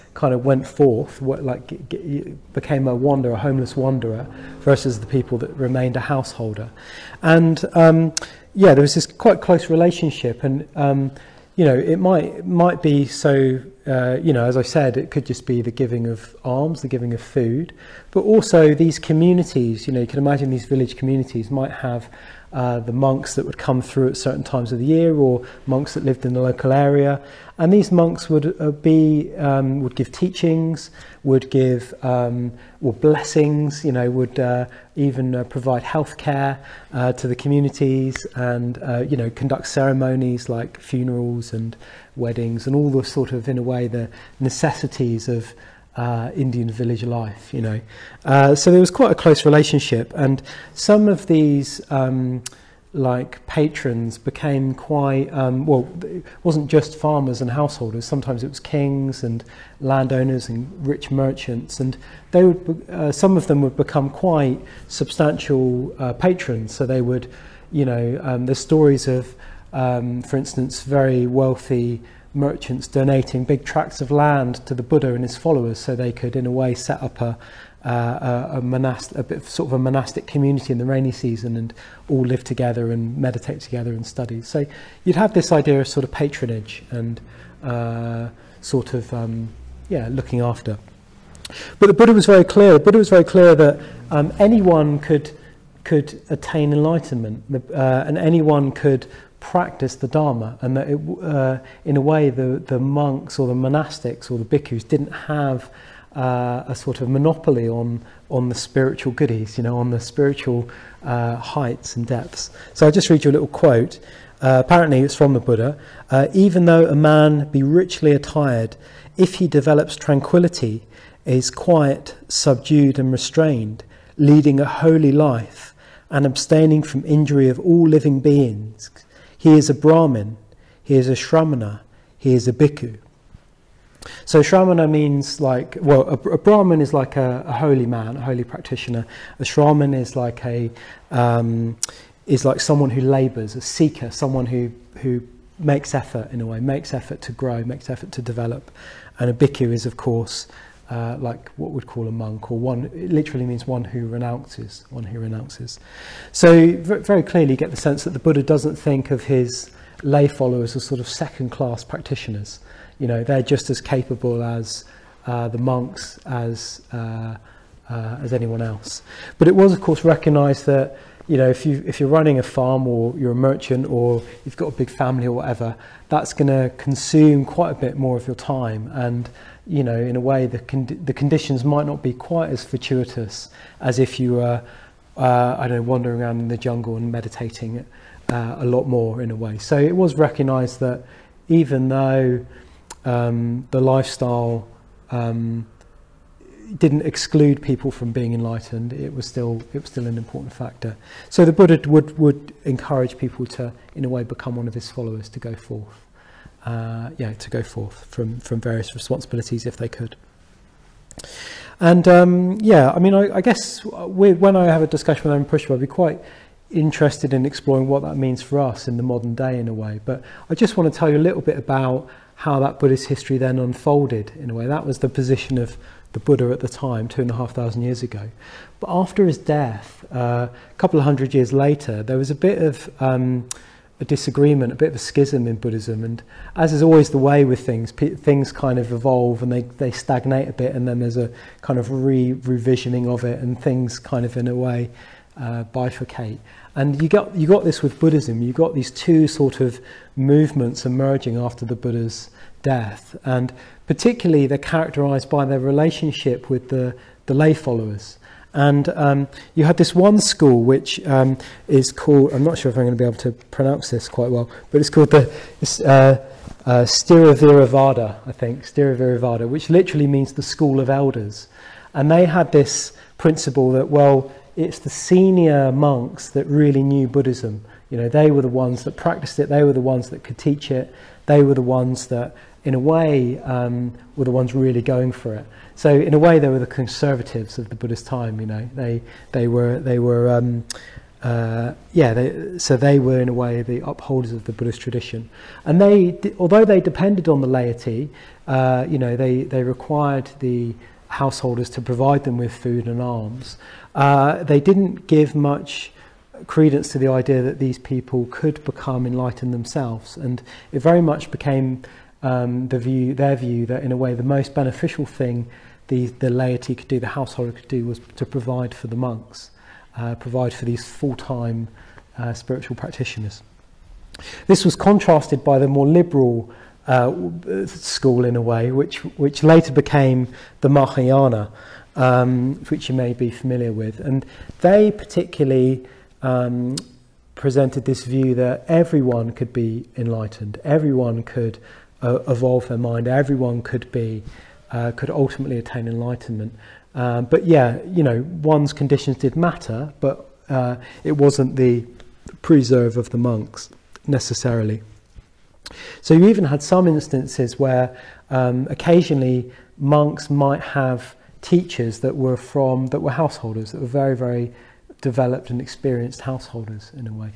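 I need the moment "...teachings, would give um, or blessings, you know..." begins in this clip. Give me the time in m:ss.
0:30.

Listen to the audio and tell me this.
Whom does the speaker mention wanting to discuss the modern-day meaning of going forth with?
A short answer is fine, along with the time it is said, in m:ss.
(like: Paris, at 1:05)
Amarapuspa, at 3:35.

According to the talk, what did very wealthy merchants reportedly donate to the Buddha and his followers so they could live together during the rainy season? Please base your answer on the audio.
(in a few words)
big tracts of land.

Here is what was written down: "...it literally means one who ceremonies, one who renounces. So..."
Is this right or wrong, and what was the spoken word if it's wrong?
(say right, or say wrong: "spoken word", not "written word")
wrong: "renounces", not "ceremonies".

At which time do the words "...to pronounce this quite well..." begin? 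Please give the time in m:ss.
4:23.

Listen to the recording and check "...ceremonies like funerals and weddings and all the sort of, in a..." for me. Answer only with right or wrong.
right.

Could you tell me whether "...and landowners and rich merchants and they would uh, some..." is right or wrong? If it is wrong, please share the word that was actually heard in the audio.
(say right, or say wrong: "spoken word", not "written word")
right.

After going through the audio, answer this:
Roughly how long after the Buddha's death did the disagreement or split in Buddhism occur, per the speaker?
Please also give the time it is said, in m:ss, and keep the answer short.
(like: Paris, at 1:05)
a couple of hundred years, at 3:50.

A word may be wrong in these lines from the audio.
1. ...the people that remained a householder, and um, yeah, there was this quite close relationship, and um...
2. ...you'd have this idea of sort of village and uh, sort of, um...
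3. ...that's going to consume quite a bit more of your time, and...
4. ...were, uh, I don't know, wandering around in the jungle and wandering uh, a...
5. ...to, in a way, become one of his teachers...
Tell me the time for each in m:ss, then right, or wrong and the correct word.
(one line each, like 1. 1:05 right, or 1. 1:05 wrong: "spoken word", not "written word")
1. 0:04 right
2. 1:25 wrong: "patronage", not "village"
3. 2:56 right
4. 3:04 wrong: "meditating", not "wandering"
5. 3:23 wrong: "followers", not "teachers".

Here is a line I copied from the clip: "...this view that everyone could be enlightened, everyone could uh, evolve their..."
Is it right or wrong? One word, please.
right.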